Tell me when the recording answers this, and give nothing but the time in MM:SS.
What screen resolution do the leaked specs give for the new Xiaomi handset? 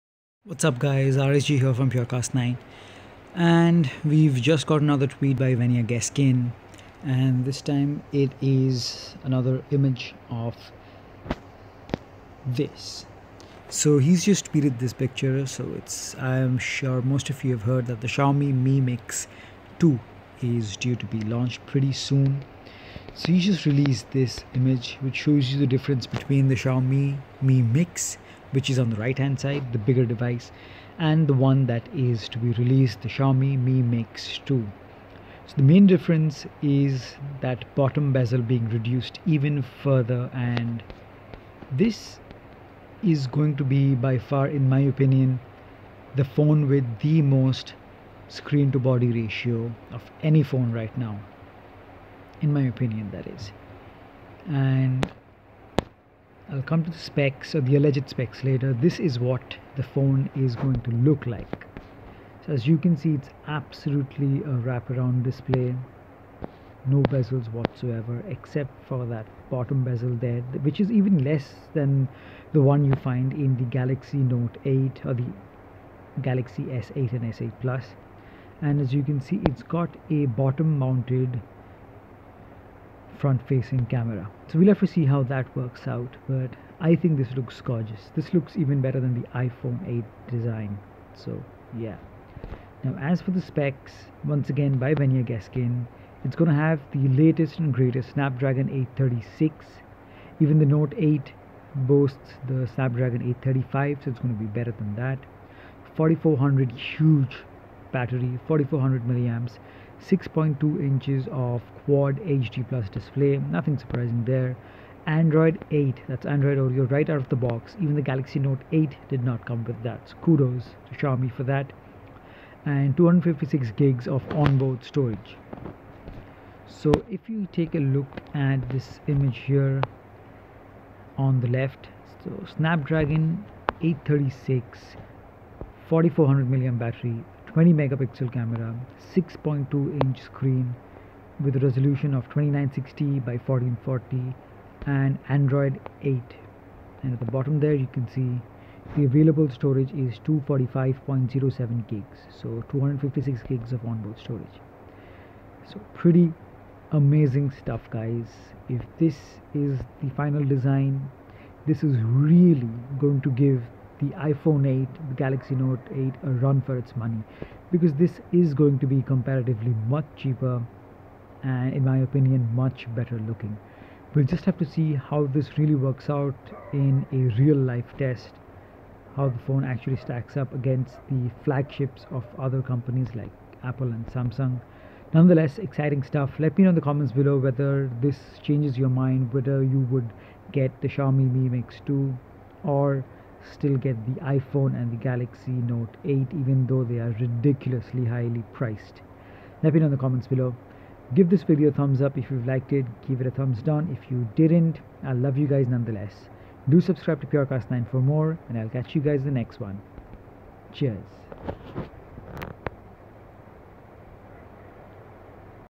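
02:22.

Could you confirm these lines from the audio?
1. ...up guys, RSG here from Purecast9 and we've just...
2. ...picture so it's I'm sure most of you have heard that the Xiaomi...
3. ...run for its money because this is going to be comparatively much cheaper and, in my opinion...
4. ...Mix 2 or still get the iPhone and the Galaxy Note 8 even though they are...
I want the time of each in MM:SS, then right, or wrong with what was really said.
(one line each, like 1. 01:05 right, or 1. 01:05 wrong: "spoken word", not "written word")
1. 00:00 right
2. 00:14 right
3. 02:46 right
4. 03:11 right.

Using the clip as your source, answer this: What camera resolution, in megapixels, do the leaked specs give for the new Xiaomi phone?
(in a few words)
20 megapixels.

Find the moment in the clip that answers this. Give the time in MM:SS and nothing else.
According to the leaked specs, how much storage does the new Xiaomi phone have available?
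02:30.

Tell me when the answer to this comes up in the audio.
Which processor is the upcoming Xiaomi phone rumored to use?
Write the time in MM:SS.
01:38.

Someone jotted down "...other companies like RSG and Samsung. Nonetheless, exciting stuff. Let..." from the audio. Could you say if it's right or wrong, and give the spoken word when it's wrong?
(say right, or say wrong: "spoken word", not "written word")
wrong: "Apple", not "RSG".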